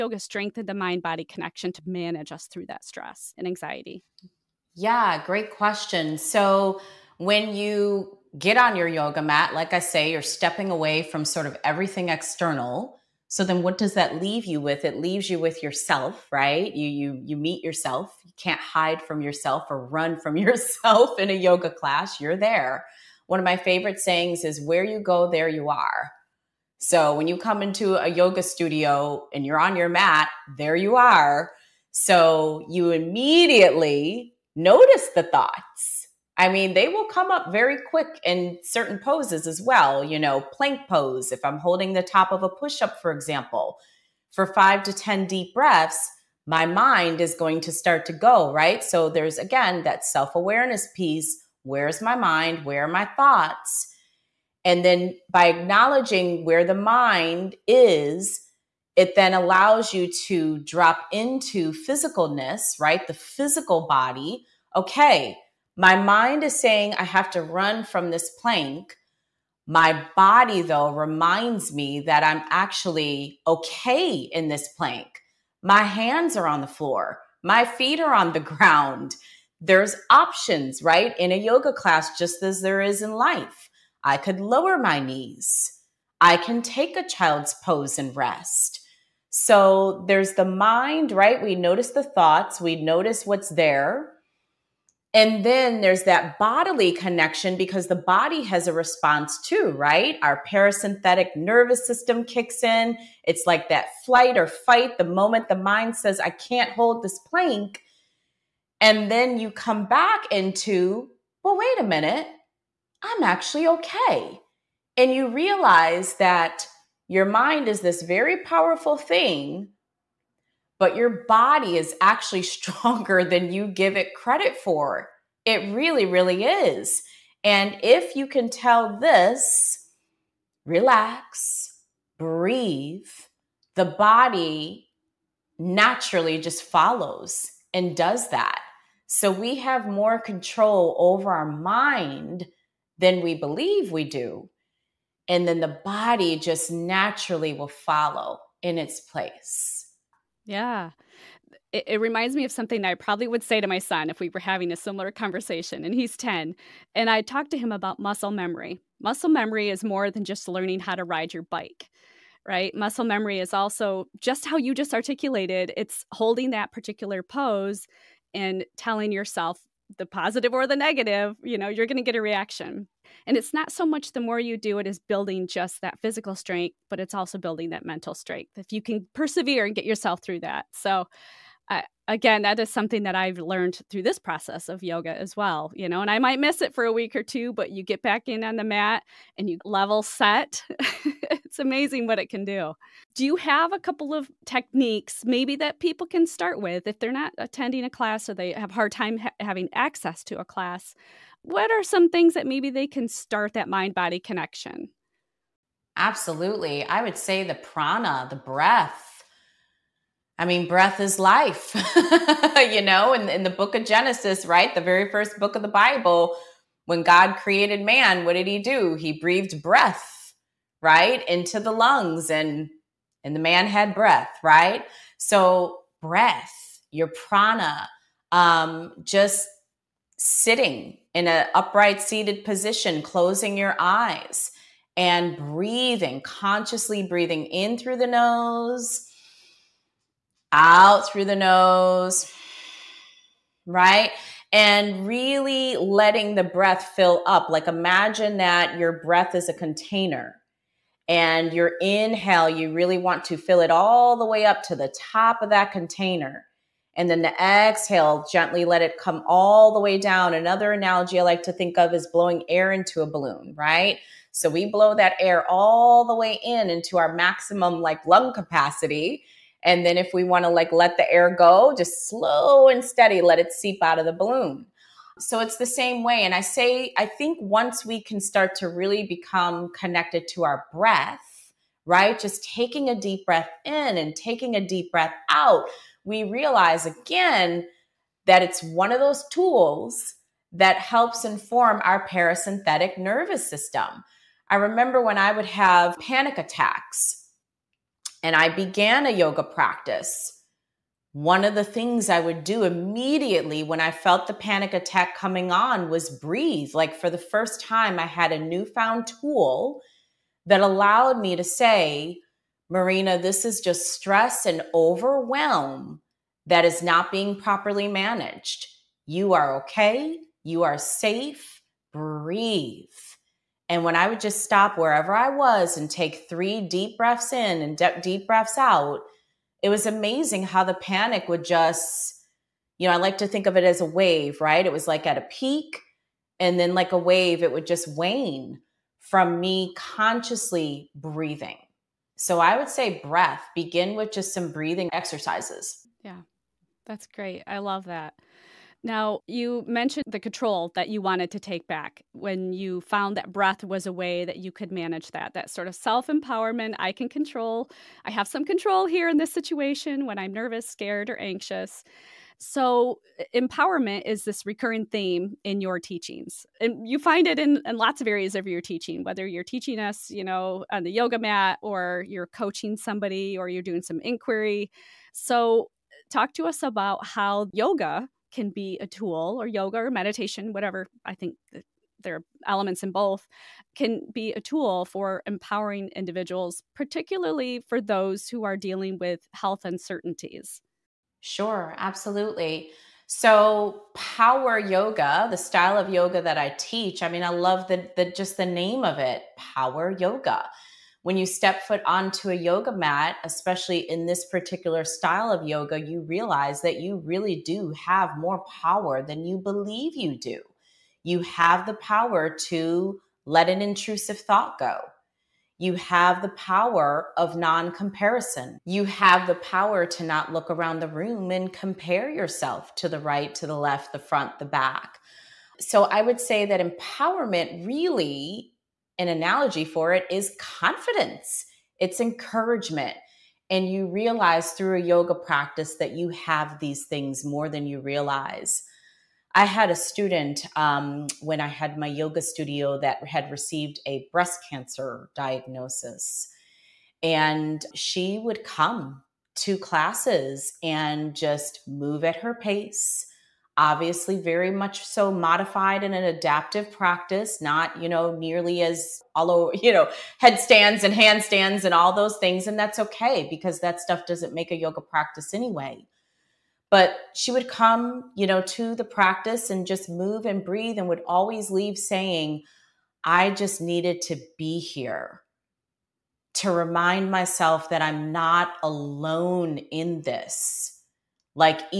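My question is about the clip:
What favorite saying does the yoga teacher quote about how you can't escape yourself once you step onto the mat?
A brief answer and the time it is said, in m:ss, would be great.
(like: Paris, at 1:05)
Where you go there you are, at 0:24.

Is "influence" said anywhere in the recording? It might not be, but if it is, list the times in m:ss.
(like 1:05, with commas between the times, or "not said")
not said.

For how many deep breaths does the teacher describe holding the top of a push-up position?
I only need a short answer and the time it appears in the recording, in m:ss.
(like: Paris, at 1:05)
5 to 10, at 0:44.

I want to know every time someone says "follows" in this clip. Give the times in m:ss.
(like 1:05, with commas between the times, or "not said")
2:16, 2:27.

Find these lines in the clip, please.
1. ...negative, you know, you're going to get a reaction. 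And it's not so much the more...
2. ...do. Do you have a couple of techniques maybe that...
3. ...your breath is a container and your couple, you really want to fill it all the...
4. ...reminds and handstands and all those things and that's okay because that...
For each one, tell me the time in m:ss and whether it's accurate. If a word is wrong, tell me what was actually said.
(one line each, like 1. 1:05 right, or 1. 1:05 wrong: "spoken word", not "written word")
1. 2:50 right
2. 3:12 right
3. 4:08 wrong: "inhale", not "couple"
4. 7:40 wrong: "headstands", not "reminds".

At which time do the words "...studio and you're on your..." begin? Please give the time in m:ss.
0:28.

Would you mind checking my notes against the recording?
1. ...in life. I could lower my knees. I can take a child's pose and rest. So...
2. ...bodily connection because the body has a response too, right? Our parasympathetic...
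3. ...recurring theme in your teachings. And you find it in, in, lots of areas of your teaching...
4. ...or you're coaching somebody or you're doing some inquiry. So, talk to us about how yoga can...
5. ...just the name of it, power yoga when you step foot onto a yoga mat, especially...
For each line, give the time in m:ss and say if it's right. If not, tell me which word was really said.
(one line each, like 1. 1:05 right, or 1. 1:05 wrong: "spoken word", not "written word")
1. 1:23 right
2. 1:36 right
3. 6:04 right
4. 6:11 right
5. 6:38 right.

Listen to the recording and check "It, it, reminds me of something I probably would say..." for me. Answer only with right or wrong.
right.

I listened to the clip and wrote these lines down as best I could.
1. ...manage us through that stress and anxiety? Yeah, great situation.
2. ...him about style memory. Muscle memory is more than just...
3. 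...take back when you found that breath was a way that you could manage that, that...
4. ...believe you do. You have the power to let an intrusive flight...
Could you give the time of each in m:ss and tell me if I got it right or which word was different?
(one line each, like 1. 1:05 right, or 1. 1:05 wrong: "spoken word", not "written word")
1. 0:01 wrong: "question", not "situation"
2. 2:37 wrong: "muscle", not "style"
3. 5:51 right
4. 6:49 wrong: "thought", not "flight".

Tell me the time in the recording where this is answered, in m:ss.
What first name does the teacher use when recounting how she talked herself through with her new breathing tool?
5:12.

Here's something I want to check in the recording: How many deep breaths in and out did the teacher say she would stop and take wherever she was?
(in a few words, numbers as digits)
3.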